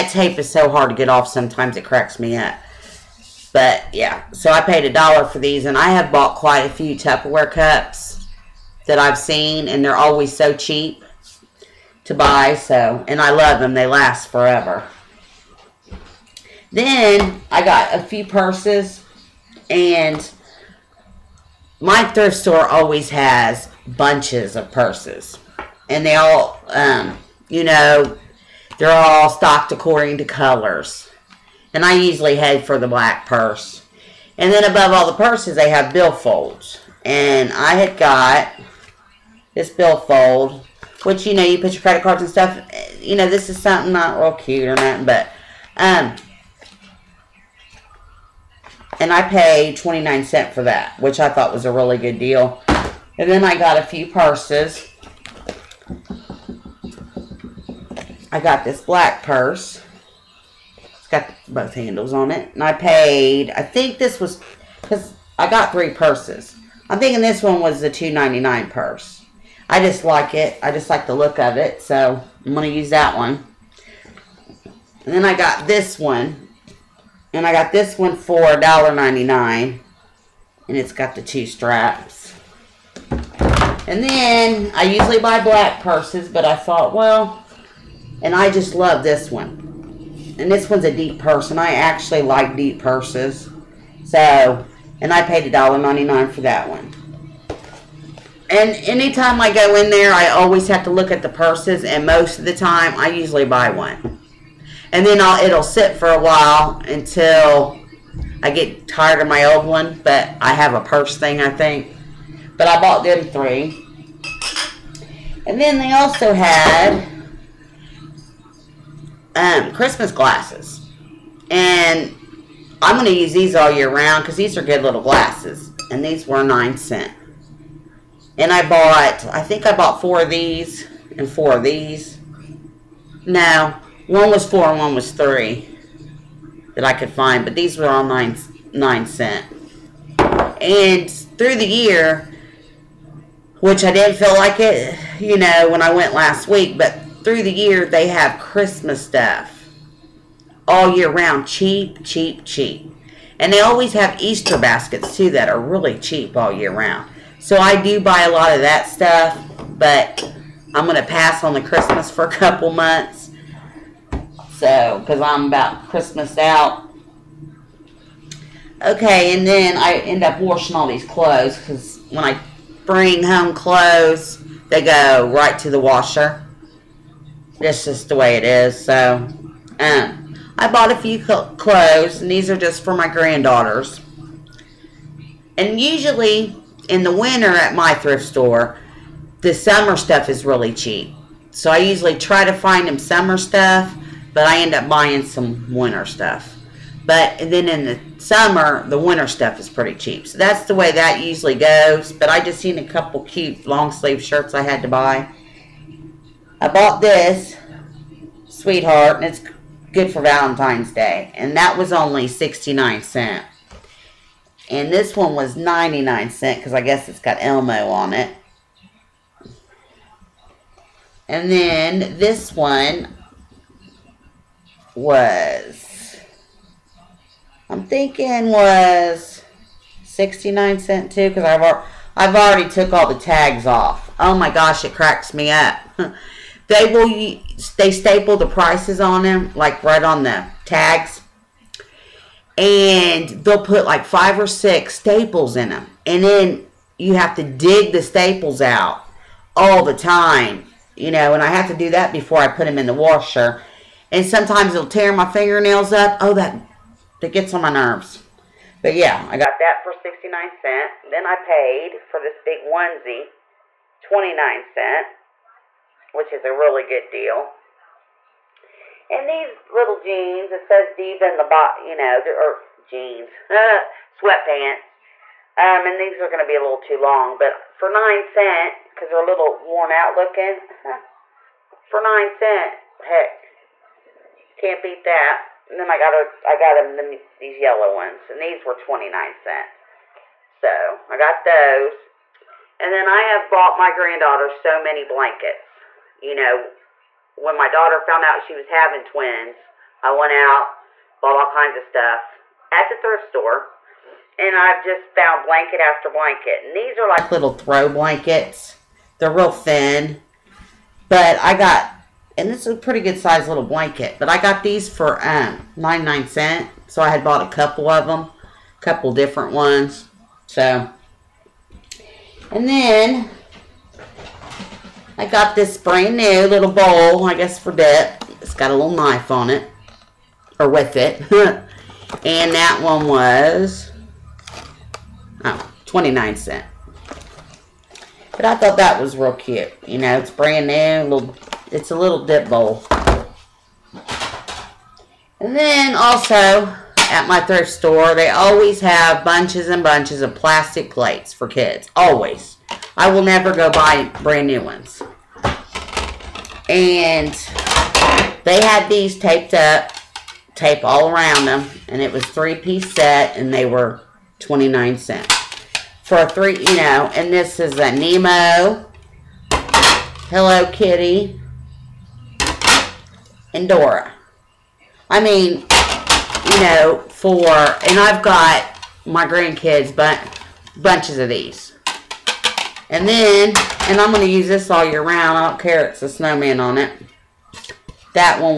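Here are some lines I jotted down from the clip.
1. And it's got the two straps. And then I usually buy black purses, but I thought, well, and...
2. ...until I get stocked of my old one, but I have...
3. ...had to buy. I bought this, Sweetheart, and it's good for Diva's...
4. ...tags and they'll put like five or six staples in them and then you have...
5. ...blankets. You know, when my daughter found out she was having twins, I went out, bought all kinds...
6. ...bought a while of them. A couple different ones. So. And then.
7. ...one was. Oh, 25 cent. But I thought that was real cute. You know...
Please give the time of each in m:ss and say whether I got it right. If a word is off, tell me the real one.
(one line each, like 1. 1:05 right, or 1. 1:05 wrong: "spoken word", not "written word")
1. 1:20 right
2. 1:46 wrong: "tired", not "stocked"
3. 3:24 wrong: "Valentine", not "Diva"
4. 4:00 right
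5. 4:55 right
6. 5:17 wrong: "couple", not "while"
7. 5:32 wrong: "29", not "25".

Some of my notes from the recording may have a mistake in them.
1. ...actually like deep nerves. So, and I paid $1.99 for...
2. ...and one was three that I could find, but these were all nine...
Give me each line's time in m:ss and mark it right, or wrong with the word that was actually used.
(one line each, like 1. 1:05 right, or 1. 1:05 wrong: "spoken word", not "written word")
1. 1:31 wrong: "purses", not "nerves"
2. 2:14 right.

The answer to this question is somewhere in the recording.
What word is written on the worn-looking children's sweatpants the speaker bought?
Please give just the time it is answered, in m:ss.
4:30.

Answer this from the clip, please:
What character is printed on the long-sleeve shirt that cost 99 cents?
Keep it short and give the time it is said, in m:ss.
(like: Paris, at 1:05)
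Elmo, at 3:37.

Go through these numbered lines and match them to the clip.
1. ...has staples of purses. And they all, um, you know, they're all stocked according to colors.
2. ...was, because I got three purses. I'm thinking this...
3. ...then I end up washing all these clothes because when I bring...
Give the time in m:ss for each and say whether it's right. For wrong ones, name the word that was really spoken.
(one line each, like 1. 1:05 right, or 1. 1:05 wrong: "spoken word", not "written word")
1. 0:23 wrong: "bunches", not "staples"
2. 1:04 right
3. 2:49 right.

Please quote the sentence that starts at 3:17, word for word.
But then in the summer, the winter stuff is pretty cheap.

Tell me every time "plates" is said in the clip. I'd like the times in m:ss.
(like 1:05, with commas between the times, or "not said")
5:50.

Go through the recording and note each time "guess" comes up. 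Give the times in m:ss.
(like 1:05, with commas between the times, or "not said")
3:36, 5:27.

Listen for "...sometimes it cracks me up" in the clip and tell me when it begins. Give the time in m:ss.
0:01.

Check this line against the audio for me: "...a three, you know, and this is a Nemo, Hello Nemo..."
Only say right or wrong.
wrong.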